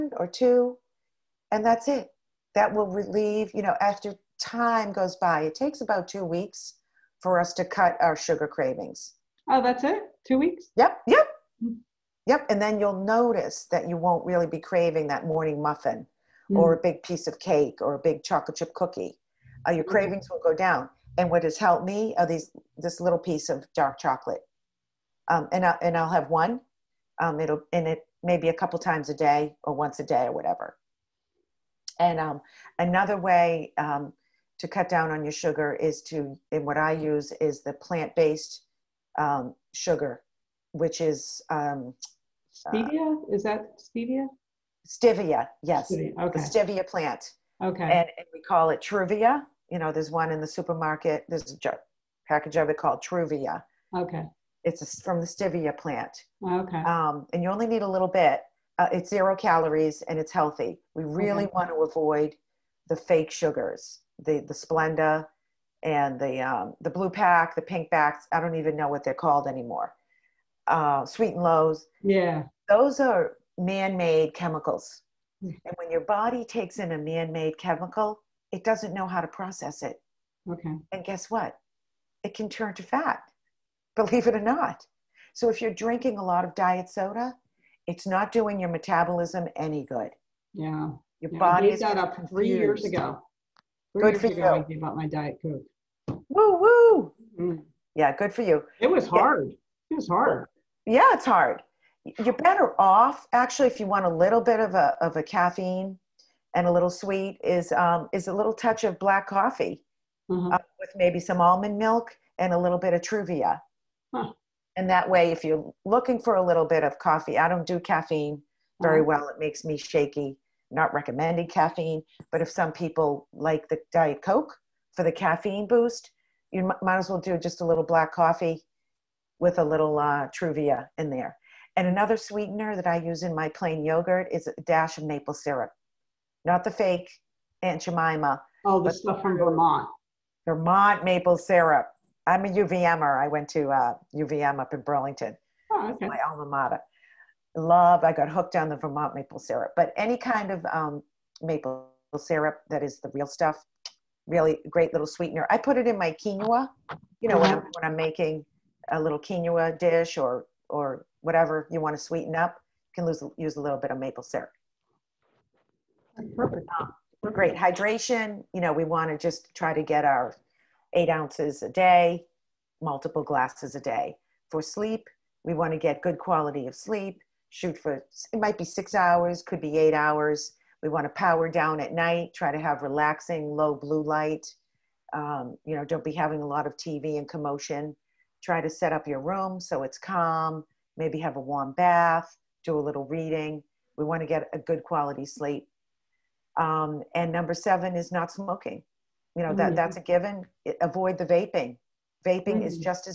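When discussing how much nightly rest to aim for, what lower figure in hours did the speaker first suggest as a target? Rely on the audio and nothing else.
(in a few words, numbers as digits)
6 hours.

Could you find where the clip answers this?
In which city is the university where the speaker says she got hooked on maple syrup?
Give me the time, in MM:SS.
02:24.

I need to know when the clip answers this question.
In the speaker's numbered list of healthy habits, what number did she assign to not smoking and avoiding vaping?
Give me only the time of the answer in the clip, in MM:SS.
03:17.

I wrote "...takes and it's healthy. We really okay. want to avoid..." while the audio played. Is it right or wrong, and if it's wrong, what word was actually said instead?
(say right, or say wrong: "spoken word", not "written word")
wrong: "calories", not "takes".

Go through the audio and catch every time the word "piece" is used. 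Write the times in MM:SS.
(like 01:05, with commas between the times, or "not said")
00:17, 00:23.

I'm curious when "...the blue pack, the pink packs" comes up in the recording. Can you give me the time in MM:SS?
01:06.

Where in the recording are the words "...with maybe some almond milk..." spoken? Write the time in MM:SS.
01:50.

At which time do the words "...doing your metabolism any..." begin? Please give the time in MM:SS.
01:28.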